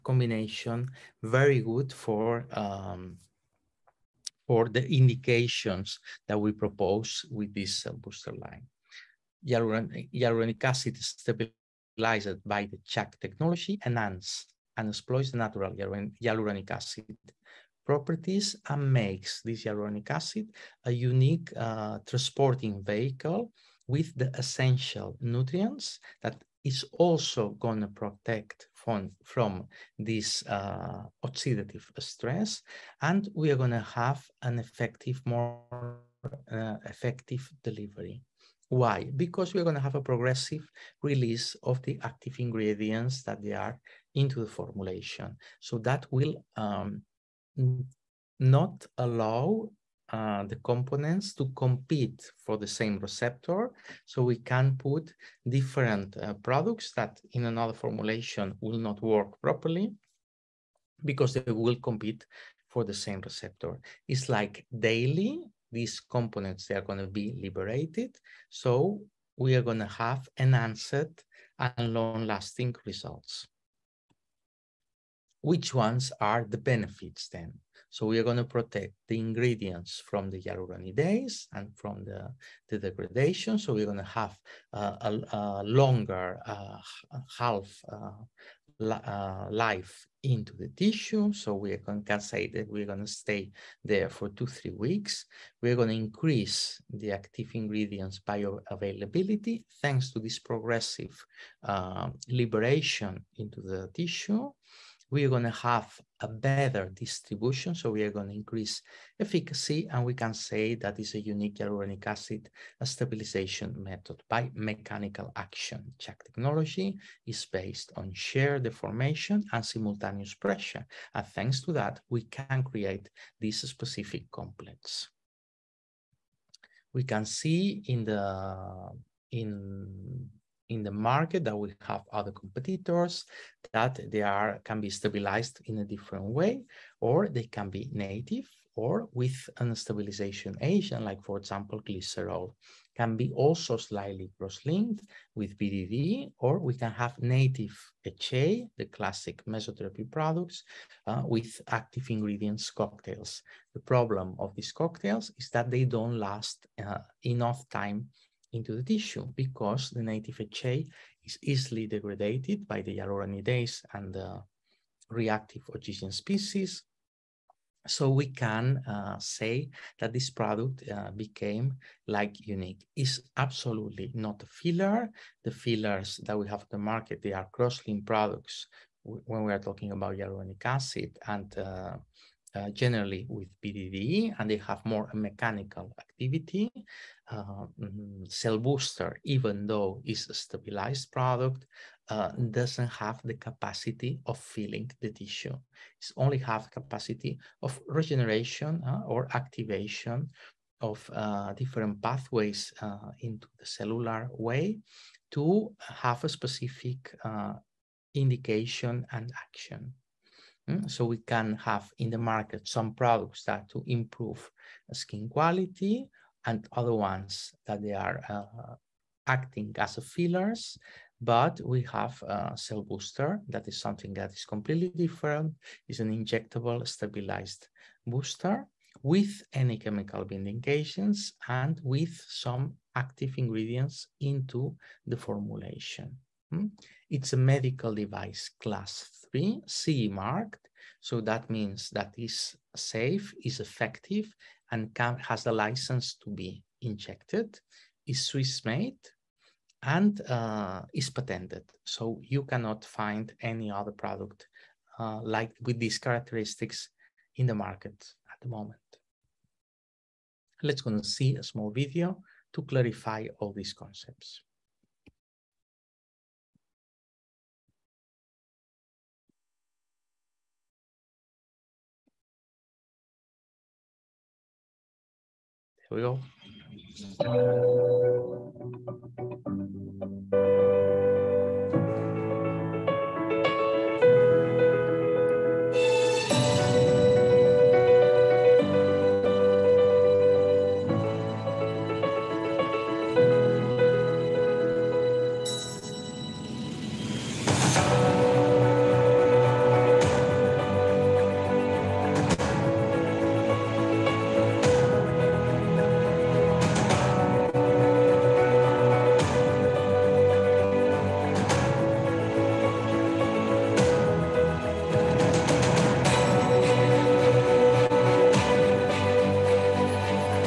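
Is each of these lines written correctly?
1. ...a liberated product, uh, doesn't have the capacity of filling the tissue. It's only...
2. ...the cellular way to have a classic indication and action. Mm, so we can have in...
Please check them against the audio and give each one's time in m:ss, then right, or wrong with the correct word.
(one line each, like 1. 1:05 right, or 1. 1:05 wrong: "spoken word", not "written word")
1. 3:10 wrong: "stabilized", not "liberated"
2. 3:23 wrong: "specific", not "classic".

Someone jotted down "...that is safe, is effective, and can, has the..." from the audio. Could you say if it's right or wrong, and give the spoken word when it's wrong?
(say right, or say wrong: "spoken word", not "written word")
right.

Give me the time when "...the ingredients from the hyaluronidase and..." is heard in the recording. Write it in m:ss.
1:19.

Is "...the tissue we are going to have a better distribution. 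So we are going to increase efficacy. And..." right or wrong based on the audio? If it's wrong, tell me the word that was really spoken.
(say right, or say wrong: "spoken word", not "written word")
right.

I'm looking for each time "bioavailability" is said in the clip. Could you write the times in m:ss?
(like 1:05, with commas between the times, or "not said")
1:38.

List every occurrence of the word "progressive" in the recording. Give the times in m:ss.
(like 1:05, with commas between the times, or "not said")
0:40, 1:40.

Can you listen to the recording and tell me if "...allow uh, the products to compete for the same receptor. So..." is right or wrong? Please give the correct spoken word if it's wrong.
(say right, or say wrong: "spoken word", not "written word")
wrong: "components", not "products".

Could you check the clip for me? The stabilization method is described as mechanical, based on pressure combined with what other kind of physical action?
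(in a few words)
Shear deformation.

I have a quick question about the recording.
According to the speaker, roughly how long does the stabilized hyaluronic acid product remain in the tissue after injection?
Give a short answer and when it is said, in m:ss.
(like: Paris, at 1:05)
2 to 3 weeks, at 1:34.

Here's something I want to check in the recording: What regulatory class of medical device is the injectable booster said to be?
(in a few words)
Class 3.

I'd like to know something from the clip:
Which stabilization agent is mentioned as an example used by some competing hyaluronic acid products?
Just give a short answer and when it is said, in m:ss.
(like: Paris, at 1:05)
Glycerol, at 2:21.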